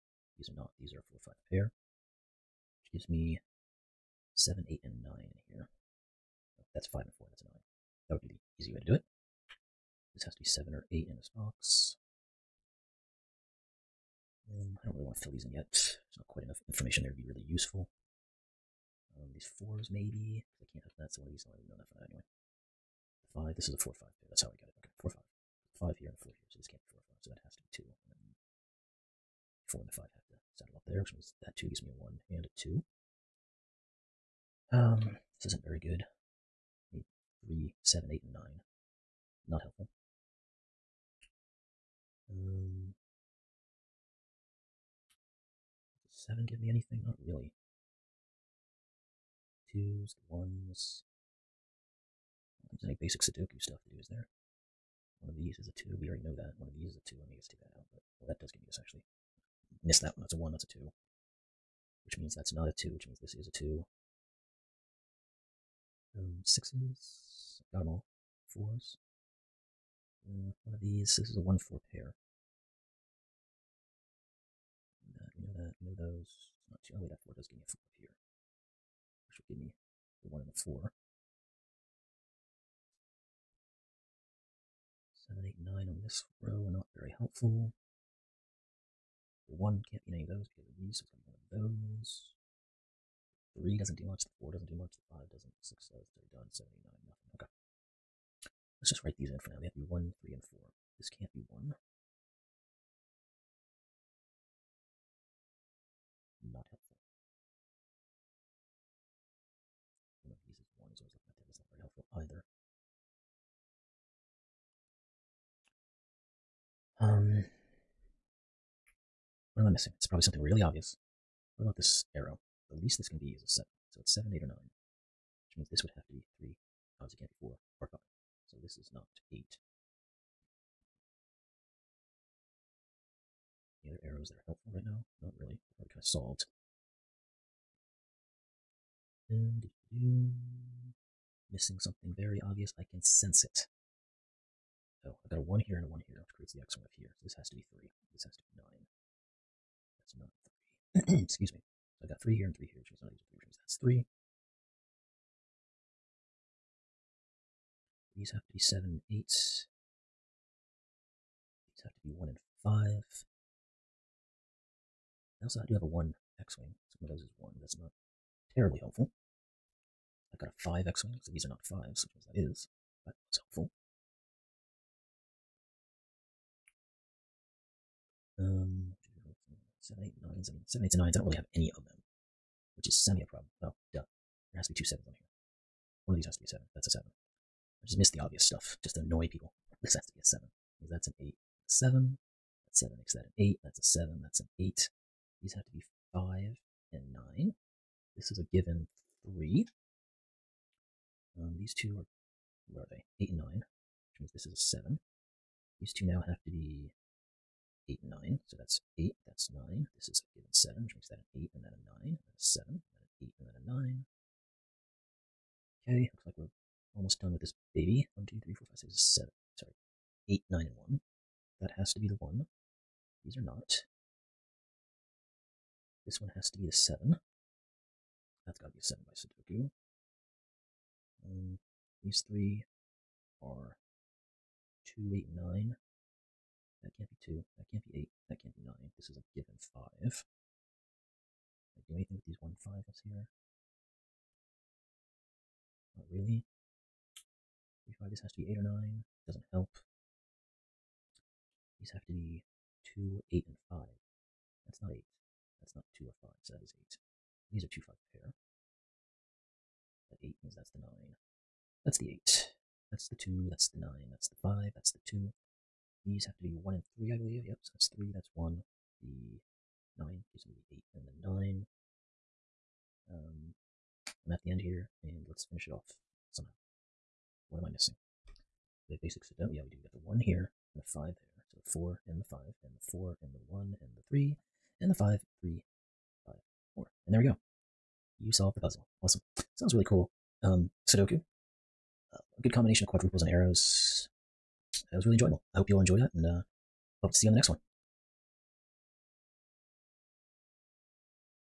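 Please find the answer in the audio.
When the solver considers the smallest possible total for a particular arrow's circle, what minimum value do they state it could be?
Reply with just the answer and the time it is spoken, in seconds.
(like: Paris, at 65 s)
7, at 122 s.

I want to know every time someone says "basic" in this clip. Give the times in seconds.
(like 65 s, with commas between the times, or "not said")
53 s, 279 s.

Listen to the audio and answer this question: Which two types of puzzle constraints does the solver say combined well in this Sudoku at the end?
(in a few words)
quadruples and arrows.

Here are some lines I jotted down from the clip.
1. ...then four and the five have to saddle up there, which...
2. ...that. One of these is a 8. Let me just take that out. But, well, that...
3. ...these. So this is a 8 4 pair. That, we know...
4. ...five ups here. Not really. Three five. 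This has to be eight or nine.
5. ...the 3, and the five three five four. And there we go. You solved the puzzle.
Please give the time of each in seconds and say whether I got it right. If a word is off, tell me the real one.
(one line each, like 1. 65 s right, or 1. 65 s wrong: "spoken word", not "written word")
1. 28 s right
2. 56 s wrong: "2", not "8"
3. 70 s wrong: "1", not "8"
4. 242 s right
5. 283 s right.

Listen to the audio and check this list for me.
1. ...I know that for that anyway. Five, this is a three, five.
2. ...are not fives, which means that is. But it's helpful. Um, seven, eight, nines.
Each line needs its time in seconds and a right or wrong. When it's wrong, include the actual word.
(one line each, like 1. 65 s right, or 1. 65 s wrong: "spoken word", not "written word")
1. 21 s wrong: "four", not "three"
2. 171 s right.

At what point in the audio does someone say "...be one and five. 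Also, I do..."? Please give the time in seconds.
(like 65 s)
162 s.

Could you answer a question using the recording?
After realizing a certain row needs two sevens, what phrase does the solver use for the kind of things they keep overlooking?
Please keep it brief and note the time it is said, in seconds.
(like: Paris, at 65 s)
the obvious stuff, at 188 s.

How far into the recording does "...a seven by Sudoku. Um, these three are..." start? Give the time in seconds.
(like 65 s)
228 s.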